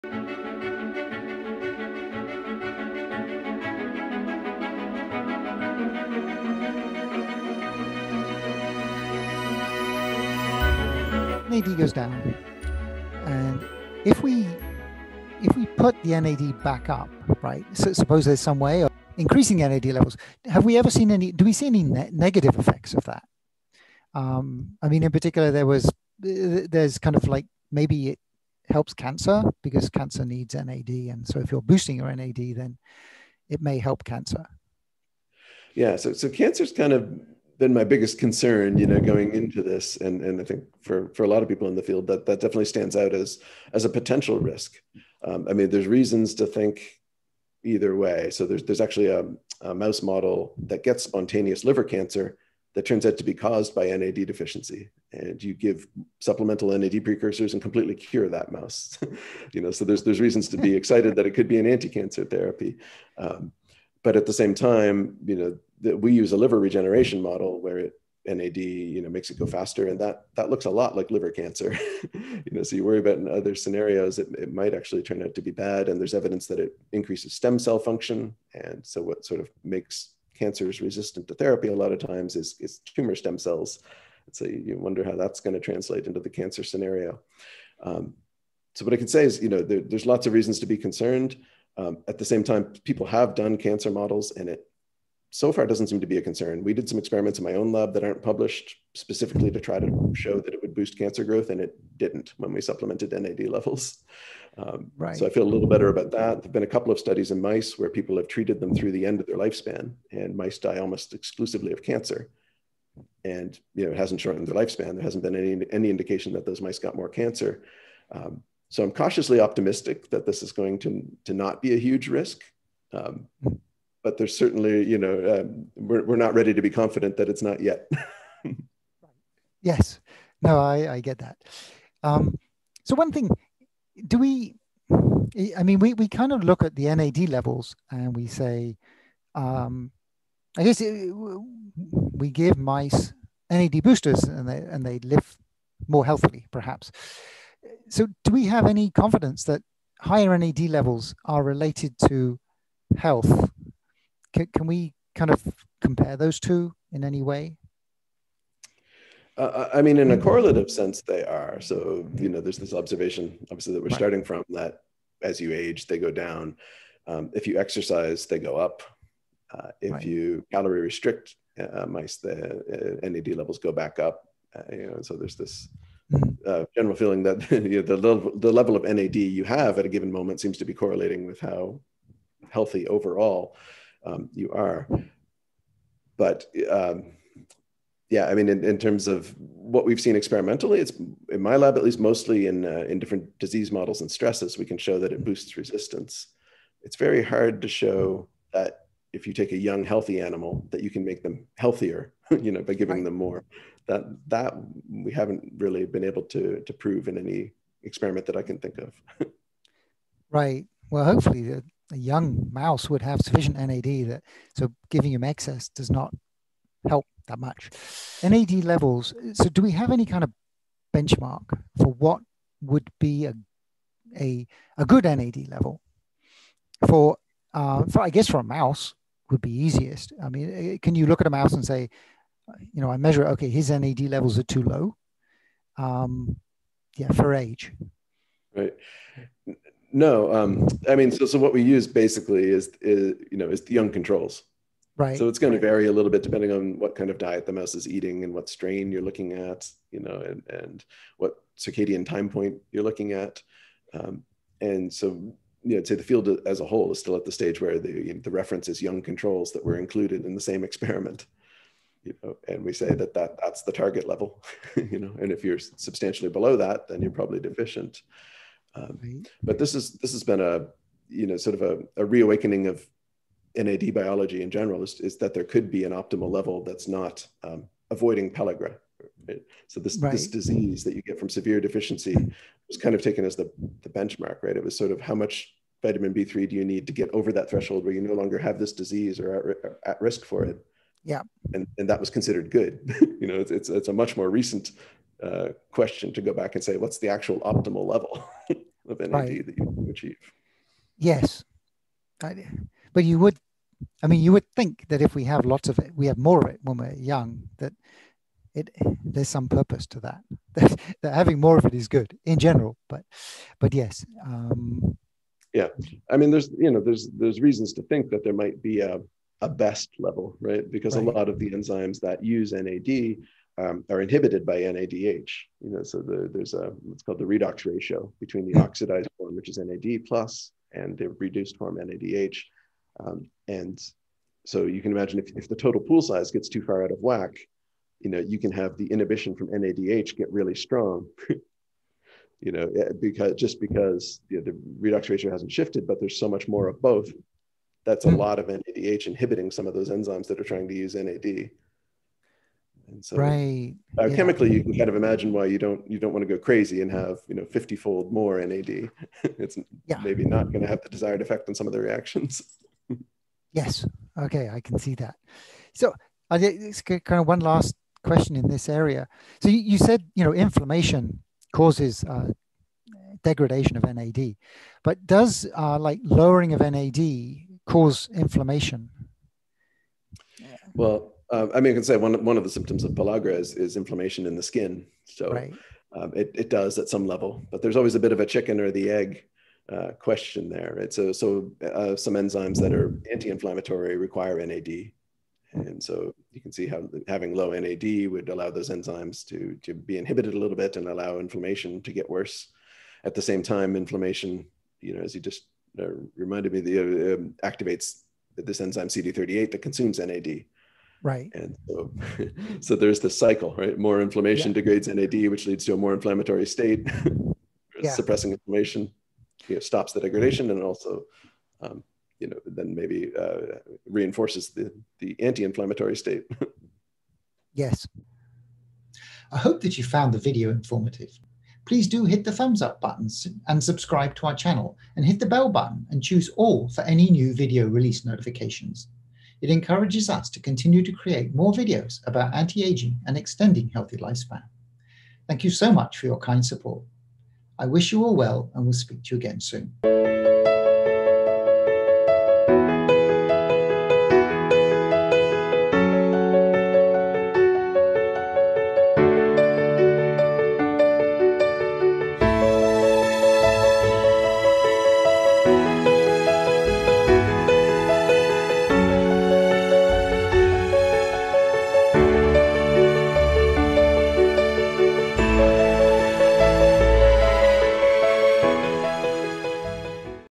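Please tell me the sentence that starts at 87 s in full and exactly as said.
Um, so what I can say is, you know, there, there's lots of reasons to be concerned.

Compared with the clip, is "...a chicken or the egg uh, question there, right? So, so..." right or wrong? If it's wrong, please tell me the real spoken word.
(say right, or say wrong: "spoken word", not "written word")
right.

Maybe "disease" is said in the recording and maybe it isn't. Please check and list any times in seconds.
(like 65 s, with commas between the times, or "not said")
193 s, 280 s, 288 s.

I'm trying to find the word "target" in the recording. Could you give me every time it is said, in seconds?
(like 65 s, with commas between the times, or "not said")
263 s.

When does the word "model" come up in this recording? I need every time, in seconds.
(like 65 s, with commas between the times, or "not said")
50 s, 67 s, 93 s, 193 s.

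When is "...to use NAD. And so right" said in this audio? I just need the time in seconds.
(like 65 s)
350 s.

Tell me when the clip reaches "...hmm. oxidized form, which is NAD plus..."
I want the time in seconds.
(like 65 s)
328 s.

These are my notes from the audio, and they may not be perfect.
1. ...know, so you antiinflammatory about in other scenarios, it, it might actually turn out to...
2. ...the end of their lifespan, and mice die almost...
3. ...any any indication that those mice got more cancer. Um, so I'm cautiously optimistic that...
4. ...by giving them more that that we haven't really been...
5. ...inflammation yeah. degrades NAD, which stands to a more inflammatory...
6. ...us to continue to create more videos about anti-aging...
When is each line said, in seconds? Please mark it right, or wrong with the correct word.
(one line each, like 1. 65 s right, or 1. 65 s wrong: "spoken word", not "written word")
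1. 72 s wrong: "worry", not "antiinflammatory"
2. 108 s right
3. 115 s right
4. 202 s right
5. 414 s wrong: "leads", not "stands"
6. 440 s right.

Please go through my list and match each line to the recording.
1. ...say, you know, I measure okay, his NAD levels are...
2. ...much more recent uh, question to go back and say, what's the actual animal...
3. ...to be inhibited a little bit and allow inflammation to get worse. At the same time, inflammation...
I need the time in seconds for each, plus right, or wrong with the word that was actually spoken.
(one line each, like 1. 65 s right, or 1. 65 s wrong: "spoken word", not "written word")
1. 231 s right
2. 293 s wrong: "optimal", not "animal"
3. 399 s right.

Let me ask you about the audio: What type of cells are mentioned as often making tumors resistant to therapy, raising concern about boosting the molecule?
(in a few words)
Tumor stem cells.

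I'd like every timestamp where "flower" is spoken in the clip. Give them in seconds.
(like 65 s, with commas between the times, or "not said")
not said.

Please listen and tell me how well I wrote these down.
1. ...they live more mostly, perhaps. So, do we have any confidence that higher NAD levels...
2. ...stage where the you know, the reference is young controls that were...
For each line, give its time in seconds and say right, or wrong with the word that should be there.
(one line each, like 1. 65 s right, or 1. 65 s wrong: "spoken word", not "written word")
1. 144 s wrong: "healthily", not "mostly"
2. 257 s right.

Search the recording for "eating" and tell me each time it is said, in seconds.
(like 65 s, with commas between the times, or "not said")
247 s.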